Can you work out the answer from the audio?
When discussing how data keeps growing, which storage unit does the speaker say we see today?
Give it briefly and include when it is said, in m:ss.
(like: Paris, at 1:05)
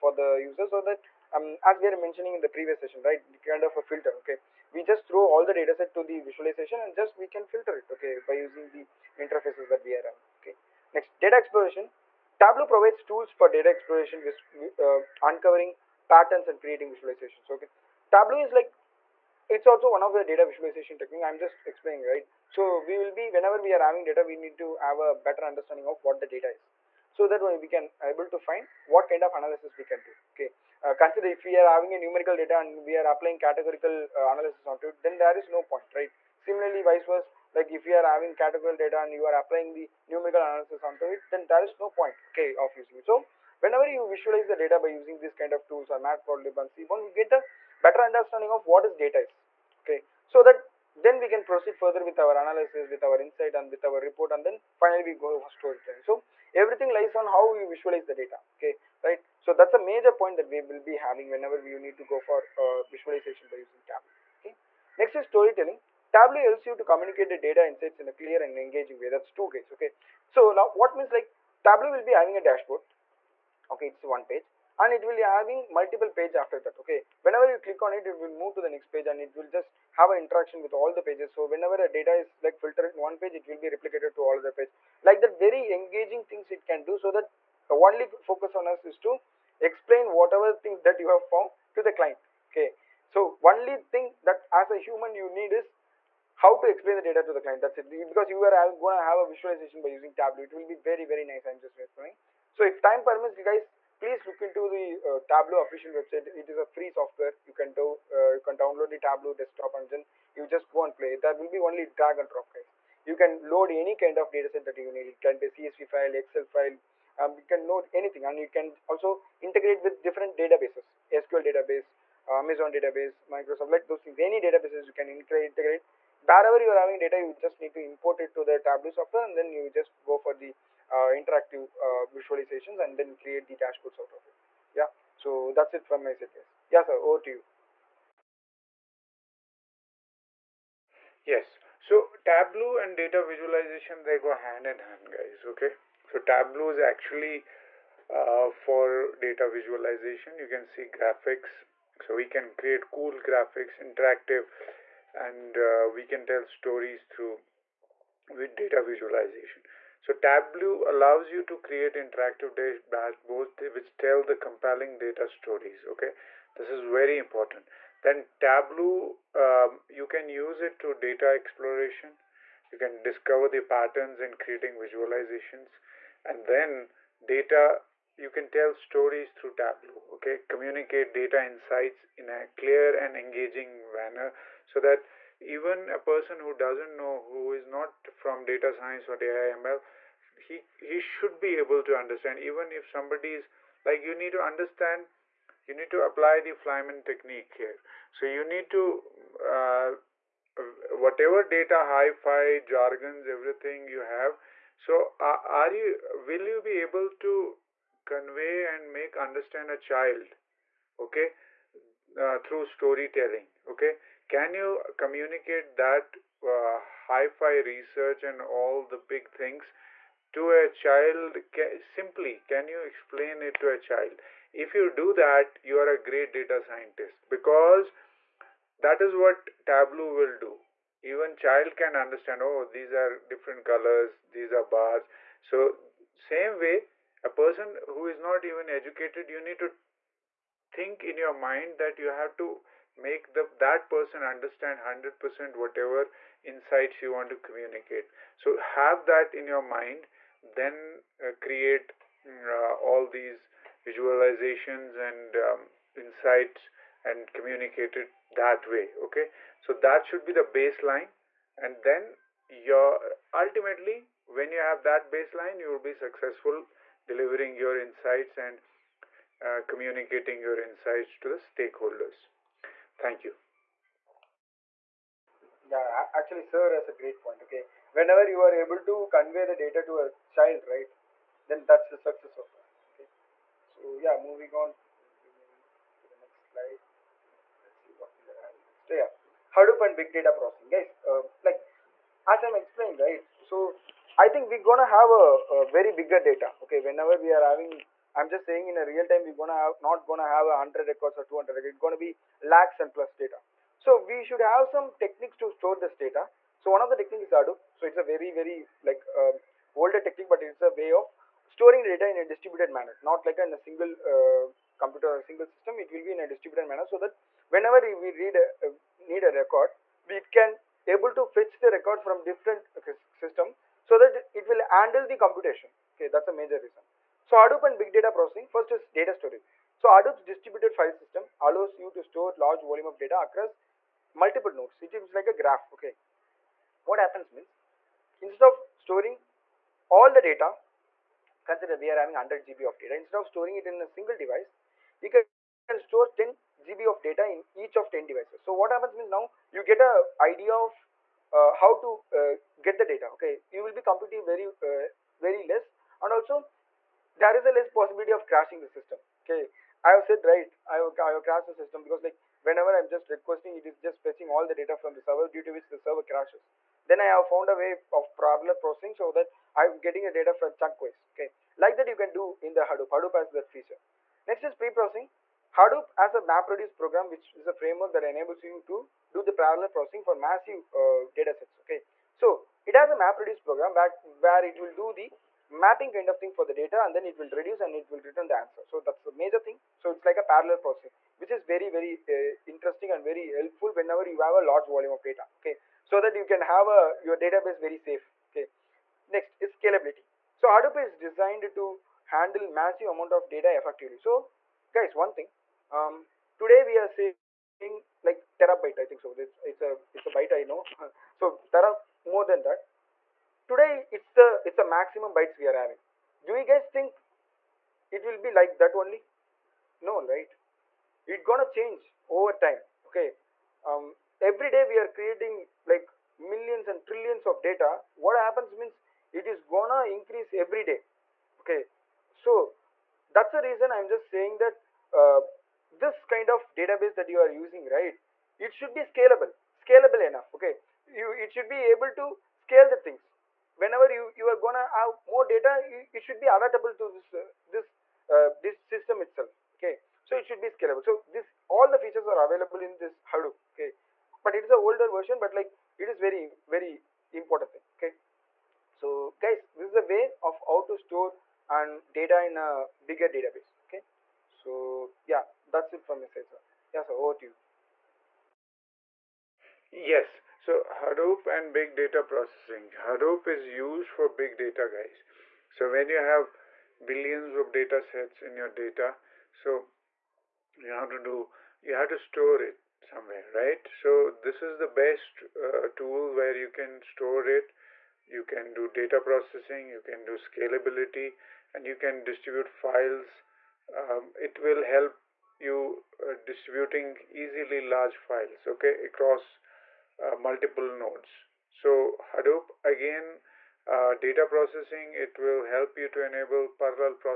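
Terabyte, at 6:48.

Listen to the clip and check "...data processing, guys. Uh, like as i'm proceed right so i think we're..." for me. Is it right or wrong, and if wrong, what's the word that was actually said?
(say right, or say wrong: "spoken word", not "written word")
wrong: "explained", not "proceed".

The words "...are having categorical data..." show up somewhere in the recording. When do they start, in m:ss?
0:37.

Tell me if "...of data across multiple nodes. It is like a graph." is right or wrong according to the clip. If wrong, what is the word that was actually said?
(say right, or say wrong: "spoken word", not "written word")
right.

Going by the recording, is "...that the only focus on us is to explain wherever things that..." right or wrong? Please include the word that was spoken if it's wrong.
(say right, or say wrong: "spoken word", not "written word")
wrong: "whatever", not "wherever".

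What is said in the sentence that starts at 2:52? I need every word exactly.
You can discover the patterns in creating visualizations, and then data you can tell stories through Tableau, okay?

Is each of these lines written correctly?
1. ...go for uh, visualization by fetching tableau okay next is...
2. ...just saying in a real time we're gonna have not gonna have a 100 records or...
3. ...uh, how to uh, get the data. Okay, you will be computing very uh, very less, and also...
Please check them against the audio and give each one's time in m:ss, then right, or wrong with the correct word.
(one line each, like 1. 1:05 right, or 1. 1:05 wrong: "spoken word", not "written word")
1. 1:02 wrong: "using", not "fetching"
2. 4:58 right
3. 5:51 right.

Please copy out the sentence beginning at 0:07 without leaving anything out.
Okay, by using the interfaces that we are on.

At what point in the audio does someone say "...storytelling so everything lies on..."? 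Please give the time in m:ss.
0:55.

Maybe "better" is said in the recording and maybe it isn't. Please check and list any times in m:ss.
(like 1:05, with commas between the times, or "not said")
0:25, 0:47.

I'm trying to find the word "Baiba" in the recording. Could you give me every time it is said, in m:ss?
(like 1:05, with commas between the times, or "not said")
not said.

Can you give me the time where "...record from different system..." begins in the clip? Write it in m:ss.
5:21.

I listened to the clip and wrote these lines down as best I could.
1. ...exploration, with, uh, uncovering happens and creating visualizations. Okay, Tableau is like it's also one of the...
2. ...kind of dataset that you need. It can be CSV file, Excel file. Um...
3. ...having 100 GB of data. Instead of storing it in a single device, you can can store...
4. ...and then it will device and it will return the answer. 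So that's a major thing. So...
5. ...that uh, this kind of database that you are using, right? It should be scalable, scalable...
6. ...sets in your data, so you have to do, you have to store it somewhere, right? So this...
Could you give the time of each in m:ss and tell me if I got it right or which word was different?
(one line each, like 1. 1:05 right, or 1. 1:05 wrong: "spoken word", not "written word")
1. 0:13 wrong: "patterns", not "happens"
2. 1:53 right
3. 5:41 right
4. 6:26 wrong: "reduce", not "device"
5. 7:14 right
6. 7:57 right.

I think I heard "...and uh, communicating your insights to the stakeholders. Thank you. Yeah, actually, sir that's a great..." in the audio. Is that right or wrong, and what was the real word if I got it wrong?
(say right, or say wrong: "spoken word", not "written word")
right.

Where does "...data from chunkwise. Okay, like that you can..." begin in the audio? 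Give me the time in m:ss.
6:10.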